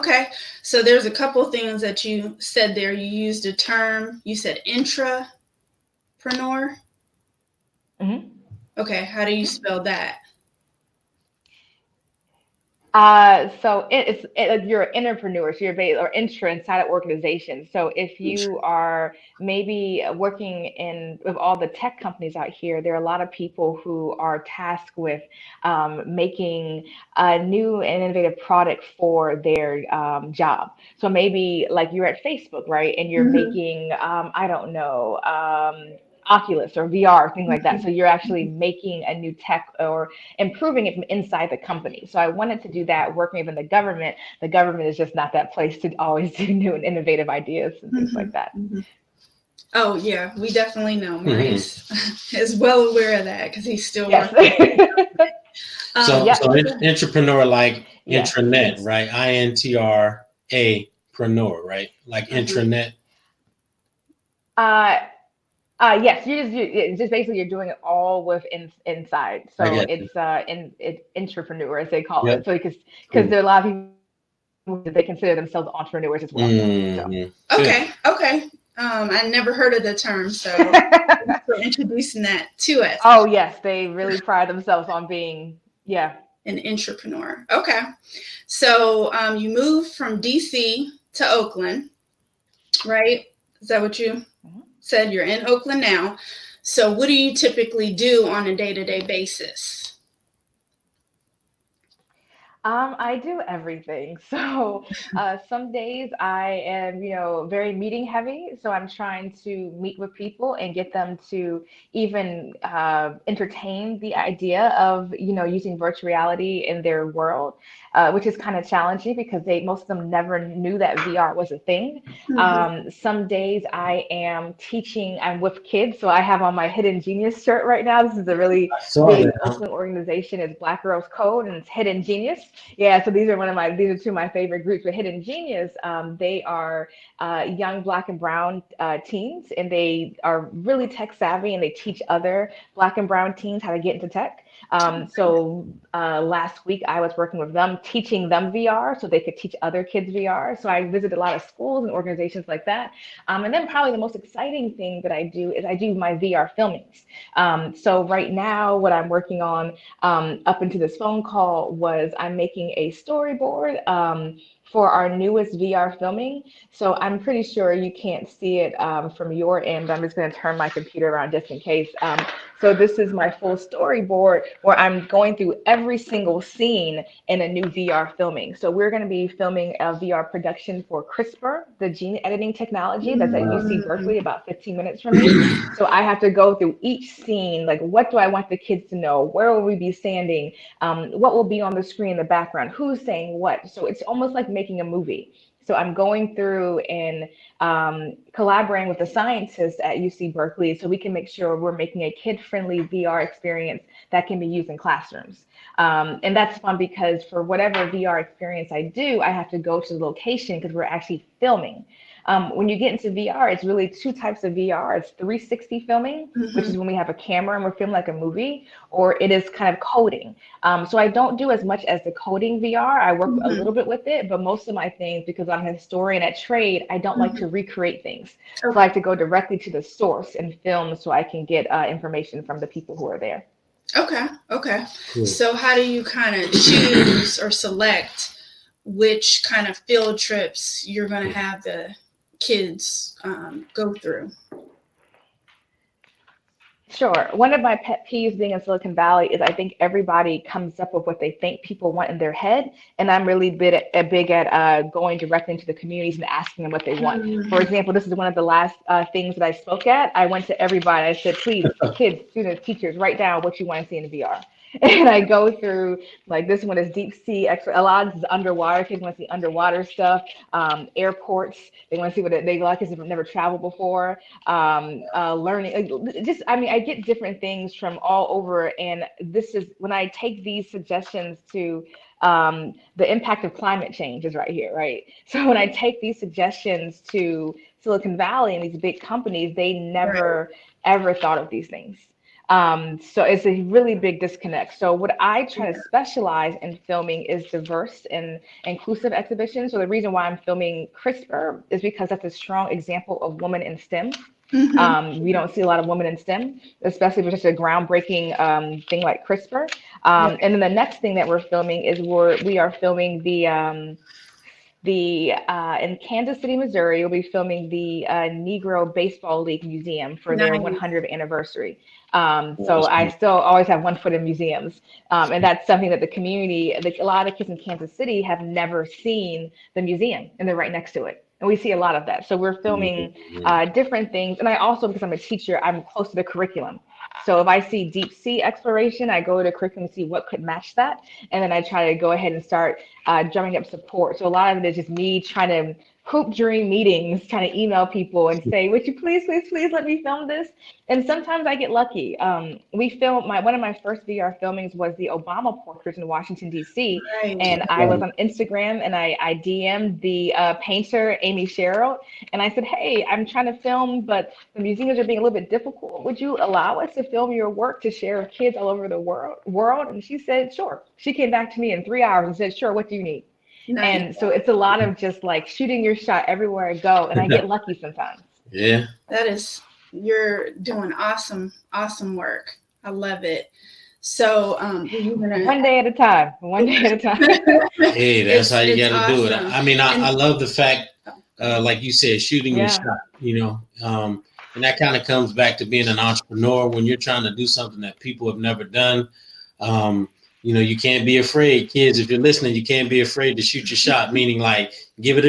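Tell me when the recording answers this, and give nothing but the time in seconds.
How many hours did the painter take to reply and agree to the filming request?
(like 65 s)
371 s.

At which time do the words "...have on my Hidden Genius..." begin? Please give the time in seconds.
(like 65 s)
126 s.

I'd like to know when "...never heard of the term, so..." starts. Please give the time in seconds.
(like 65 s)
79 s.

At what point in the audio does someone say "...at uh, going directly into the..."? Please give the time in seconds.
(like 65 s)
254 s.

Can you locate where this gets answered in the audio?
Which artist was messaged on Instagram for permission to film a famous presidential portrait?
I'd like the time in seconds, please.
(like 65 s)
361 s.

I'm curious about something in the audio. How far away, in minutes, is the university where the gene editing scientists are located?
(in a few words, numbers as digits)
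15 minutes.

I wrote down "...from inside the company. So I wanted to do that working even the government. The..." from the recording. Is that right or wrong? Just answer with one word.
right.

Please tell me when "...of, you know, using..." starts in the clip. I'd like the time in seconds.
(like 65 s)
114 s.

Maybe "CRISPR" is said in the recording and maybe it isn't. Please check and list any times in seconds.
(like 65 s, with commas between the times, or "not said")
181 s, 300 s, 309 s.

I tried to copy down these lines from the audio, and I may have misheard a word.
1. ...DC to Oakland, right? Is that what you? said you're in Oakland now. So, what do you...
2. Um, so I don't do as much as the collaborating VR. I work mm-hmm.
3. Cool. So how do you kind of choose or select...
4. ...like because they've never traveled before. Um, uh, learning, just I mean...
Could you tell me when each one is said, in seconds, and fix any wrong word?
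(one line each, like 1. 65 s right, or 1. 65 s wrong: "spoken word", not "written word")
1. 90 s right
2. 220 s wrong: "coding", not "collaborating"
3. 235 s right
4. 272 s right.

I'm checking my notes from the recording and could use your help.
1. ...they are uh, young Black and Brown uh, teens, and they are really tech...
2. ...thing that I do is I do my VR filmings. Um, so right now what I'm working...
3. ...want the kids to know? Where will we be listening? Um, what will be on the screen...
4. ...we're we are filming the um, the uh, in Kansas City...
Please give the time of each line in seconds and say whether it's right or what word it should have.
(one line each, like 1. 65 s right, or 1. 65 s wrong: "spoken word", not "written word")
1. 136 s right
2. 154 s right
3. 188 s wrong: "standing", not "listening"
4. 311 s right.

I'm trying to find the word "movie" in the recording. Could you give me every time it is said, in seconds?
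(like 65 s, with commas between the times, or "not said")
194 s, 218 s.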